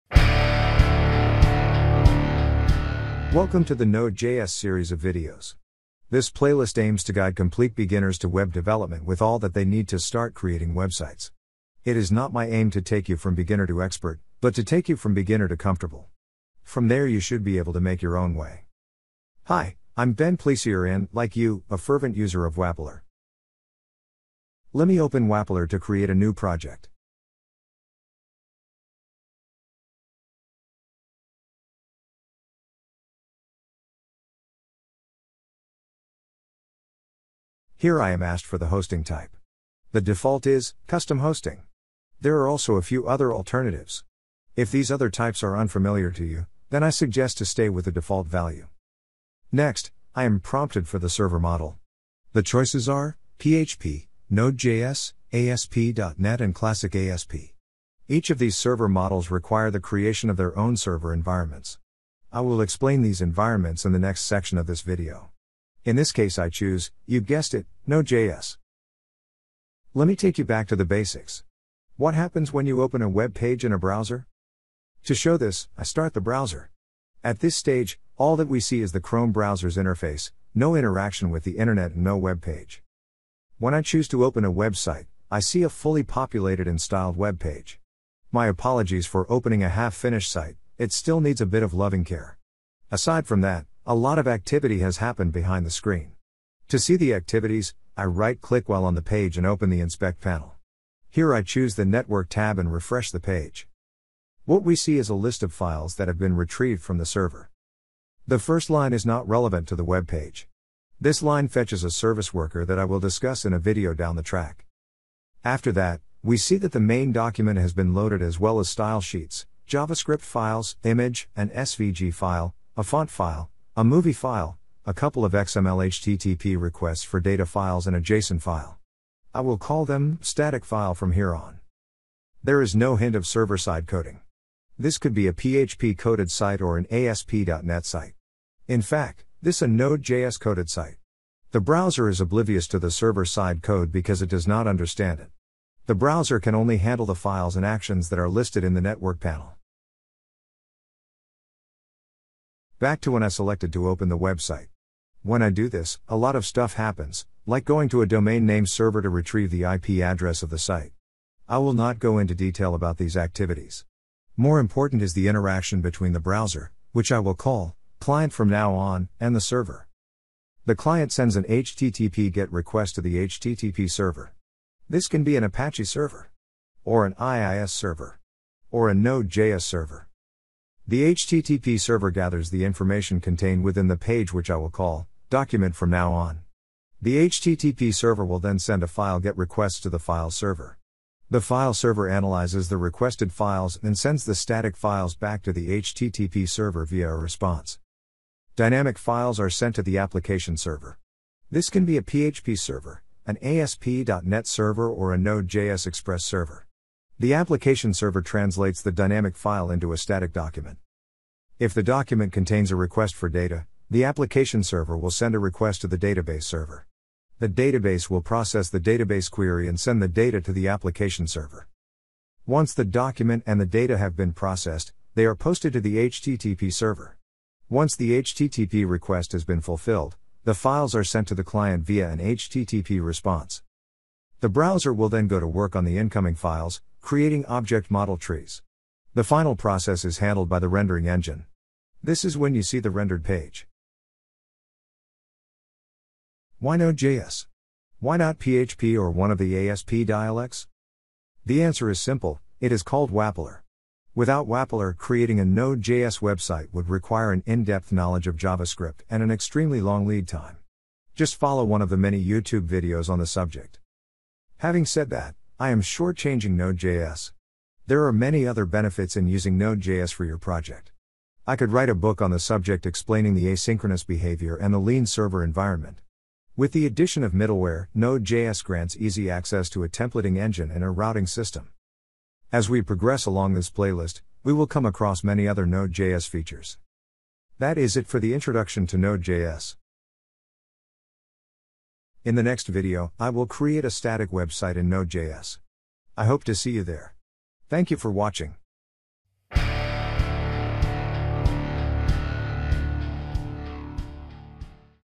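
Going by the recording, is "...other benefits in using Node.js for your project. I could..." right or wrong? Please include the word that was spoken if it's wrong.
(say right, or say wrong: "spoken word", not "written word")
right.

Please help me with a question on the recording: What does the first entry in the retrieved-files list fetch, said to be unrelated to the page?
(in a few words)
A service worker.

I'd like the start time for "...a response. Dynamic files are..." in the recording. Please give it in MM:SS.
03:17.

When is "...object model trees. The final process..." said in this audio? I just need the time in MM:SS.
03:57.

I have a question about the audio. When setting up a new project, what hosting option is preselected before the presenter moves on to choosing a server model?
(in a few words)
Custom hosting.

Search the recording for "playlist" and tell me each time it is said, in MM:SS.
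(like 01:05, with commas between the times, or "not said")
00:06, 04:43.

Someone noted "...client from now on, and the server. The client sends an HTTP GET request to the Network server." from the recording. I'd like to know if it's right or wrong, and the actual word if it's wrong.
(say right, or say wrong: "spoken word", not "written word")
wrong: "HTTP", not "Network".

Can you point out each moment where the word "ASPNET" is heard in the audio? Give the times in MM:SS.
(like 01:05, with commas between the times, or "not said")
00:55, 02:16, 03:23.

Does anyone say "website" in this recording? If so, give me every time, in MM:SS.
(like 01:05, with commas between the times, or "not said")
00:10, 01:24, 02:34, 04:16, 04:54.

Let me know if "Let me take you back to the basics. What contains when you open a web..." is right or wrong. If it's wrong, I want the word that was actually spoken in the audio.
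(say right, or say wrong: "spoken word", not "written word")
wrong: "happens", not "contains".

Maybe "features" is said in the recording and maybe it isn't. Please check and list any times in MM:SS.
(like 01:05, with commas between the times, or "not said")
04:46.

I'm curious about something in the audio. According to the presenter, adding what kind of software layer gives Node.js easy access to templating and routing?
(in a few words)
Middleware.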